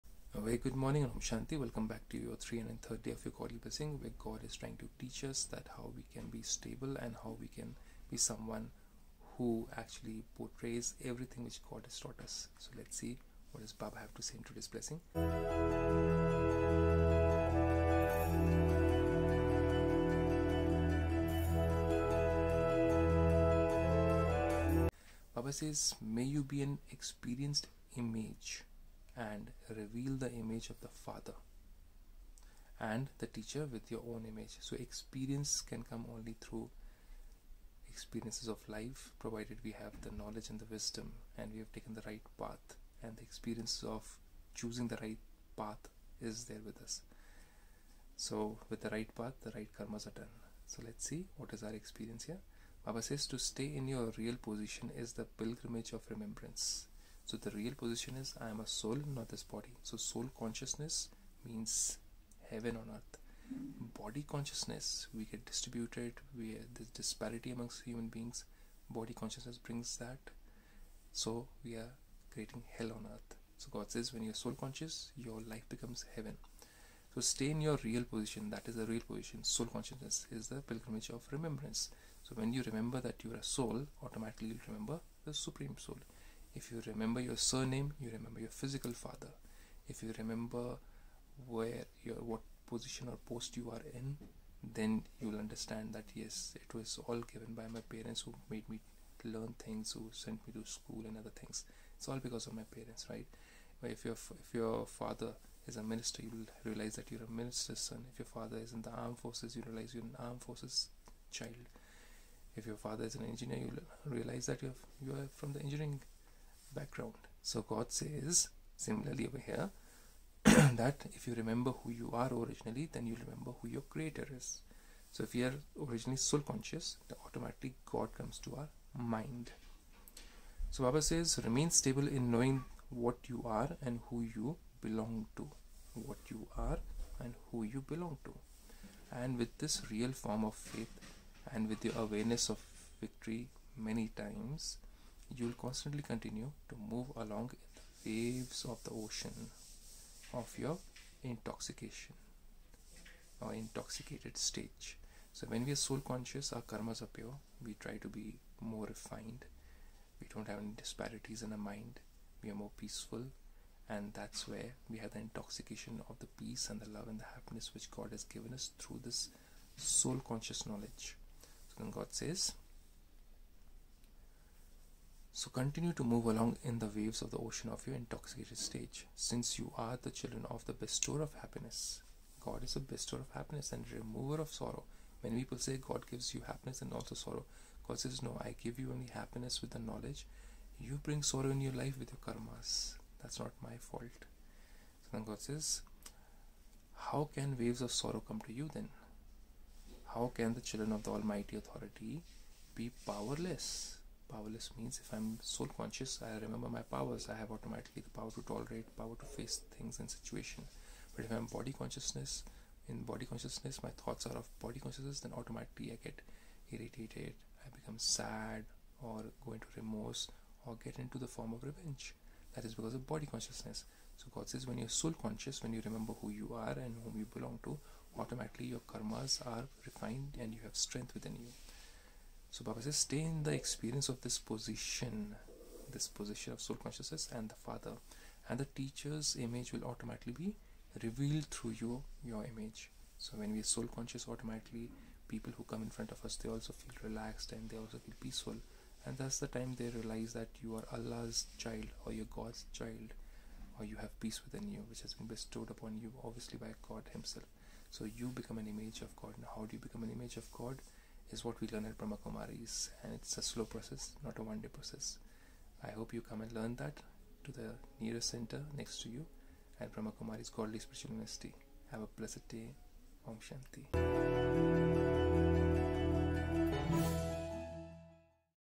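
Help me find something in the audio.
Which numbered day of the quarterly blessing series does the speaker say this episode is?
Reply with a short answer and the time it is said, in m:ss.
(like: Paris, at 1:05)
330, at 0:02.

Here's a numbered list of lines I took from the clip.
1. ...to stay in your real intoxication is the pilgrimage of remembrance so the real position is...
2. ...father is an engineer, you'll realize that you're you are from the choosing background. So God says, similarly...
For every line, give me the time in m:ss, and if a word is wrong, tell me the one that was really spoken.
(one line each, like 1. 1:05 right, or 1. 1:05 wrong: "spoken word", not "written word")
1. 0:53 wrong: "position", not "intoxication"
2. 1:52 wrong: "engineering", not "choosing".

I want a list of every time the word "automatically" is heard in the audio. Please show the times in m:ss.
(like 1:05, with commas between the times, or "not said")
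1:24, 2:07, 3:27, 3:35, 3:48, 3:59, 4:04.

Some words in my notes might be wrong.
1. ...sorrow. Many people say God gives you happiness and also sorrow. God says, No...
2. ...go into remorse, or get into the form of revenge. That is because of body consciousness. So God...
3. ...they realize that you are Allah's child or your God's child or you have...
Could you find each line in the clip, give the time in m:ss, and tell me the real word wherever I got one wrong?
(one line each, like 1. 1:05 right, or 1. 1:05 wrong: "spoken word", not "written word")
1. 3:04 right
2. 3:39 right
3. 4:09 right.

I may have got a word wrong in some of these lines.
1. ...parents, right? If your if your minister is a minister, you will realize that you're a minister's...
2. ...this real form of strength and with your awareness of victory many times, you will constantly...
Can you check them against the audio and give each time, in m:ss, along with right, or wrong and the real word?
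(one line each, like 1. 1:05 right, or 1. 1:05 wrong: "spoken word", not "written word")
1. 1:42 wrong: "father", not "minister"
2. 2:19 wrong: "faith", not "strength".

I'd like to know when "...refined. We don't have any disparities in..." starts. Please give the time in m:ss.
2:38.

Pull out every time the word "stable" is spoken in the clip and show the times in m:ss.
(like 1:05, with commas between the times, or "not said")
0:06, 2:11.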